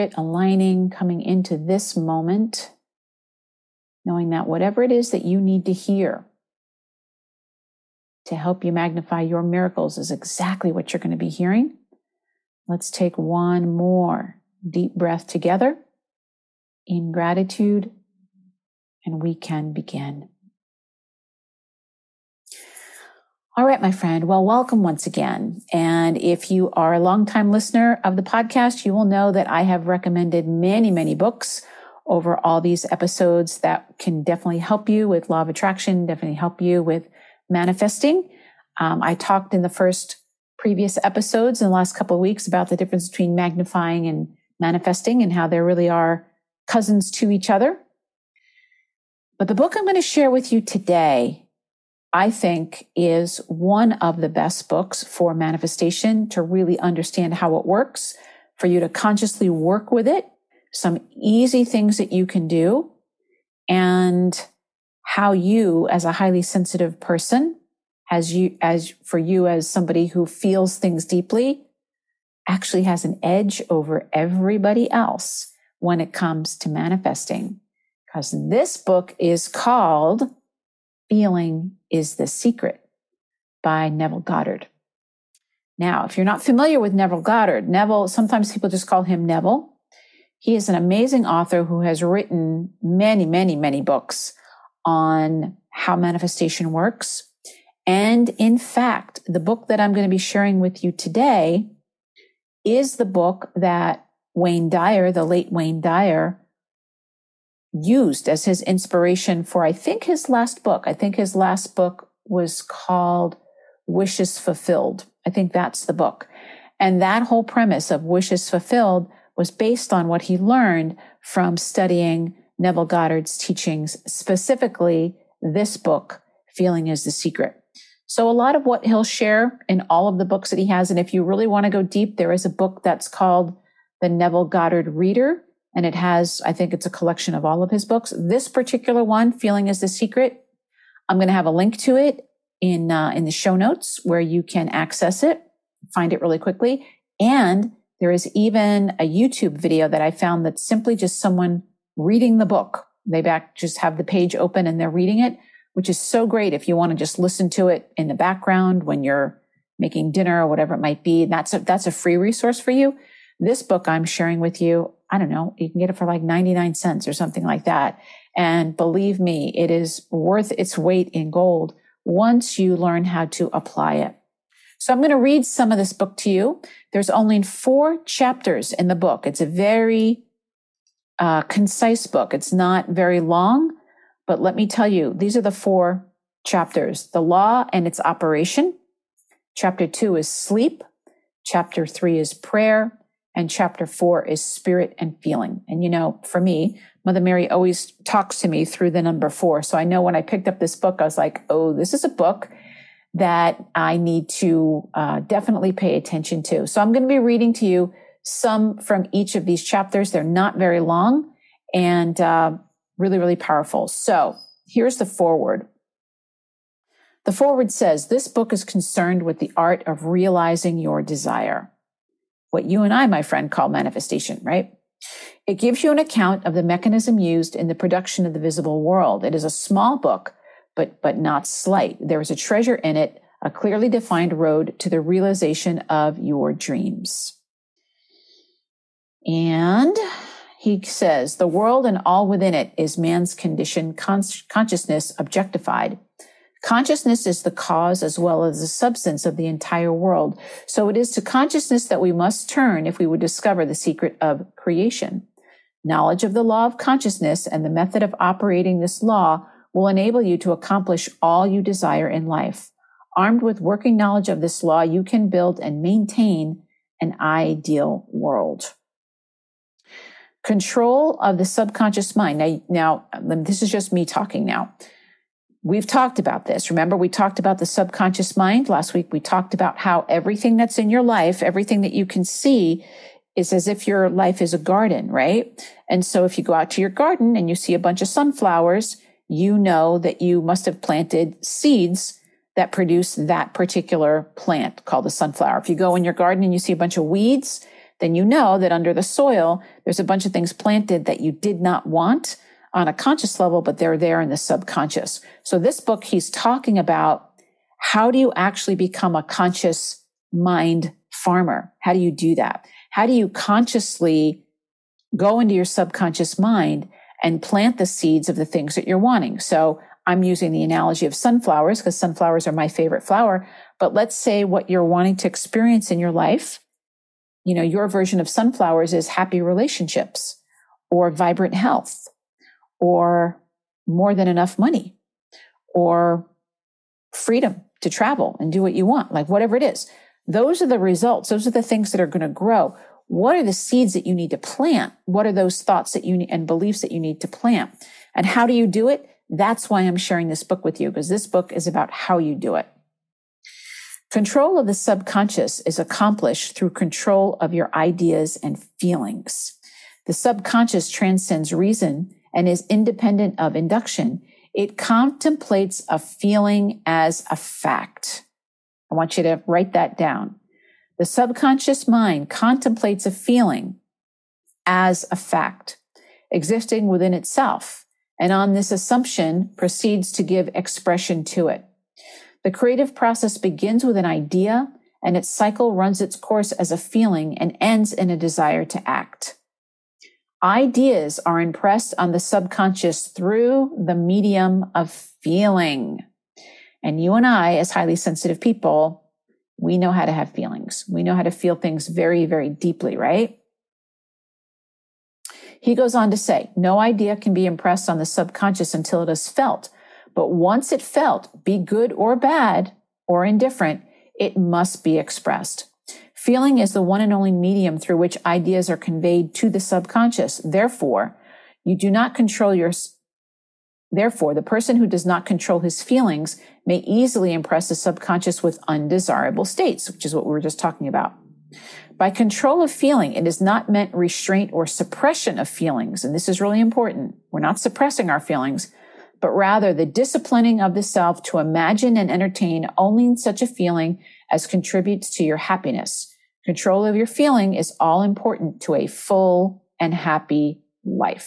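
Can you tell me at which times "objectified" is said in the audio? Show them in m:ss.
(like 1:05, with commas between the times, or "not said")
4:05.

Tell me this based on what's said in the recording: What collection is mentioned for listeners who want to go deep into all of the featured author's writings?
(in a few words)
The Neville Goddard Reader.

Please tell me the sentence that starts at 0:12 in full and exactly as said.
Let's take one more deep breath together in gratitude, and we can begin.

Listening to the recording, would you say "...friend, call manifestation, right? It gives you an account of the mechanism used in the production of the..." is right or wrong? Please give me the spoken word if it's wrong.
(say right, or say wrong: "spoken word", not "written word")
right.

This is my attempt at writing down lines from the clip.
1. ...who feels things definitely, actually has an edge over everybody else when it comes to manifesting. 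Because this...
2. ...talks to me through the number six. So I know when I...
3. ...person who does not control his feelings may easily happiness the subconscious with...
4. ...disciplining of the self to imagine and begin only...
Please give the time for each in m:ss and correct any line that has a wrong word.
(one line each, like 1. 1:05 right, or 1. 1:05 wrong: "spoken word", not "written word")
1. 1:10 wrong: "deeply", not "definitely"
2. 3:18 wrong: "four", not "six"
3. 7:04 wrong: "impress", not "happiness"
4. 7:19 wrong: "entertain", not "begin".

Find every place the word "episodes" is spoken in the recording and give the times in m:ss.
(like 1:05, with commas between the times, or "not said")
0:32, 0:41.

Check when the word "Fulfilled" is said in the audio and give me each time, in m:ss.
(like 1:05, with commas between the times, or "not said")
1:54, 1:58.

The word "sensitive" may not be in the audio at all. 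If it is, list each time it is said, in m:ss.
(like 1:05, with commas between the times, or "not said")
1:06, 6:37.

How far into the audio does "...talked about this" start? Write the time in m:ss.
4:35.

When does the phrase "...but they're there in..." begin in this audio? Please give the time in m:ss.
5:03.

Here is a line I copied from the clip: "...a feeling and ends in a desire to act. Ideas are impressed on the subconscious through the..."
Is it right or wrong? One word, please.
right.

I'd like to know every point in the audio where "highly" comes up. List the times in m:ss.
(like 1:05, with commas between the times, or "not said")
1:06, 6:37.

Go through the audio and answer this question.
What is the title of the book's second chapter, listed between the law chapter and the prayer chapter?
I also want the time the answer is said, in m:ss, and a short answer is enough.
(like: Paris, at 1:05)
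Sleep, at 3:10.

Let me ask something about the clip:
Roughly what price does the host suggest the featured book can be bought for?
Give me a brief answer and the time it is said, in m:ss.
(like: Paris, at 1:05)
99 cents, at 2:46.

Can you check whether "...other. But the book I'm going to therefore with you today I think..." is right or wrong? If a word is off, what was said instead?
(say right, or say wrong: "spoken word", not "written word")
wrong: "share", not "therefore".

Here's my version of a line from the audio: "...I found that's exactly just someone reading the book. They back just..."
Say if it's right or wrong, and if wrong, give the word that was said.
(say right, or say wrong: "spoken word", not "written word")
wrong: "simply", not "exactly".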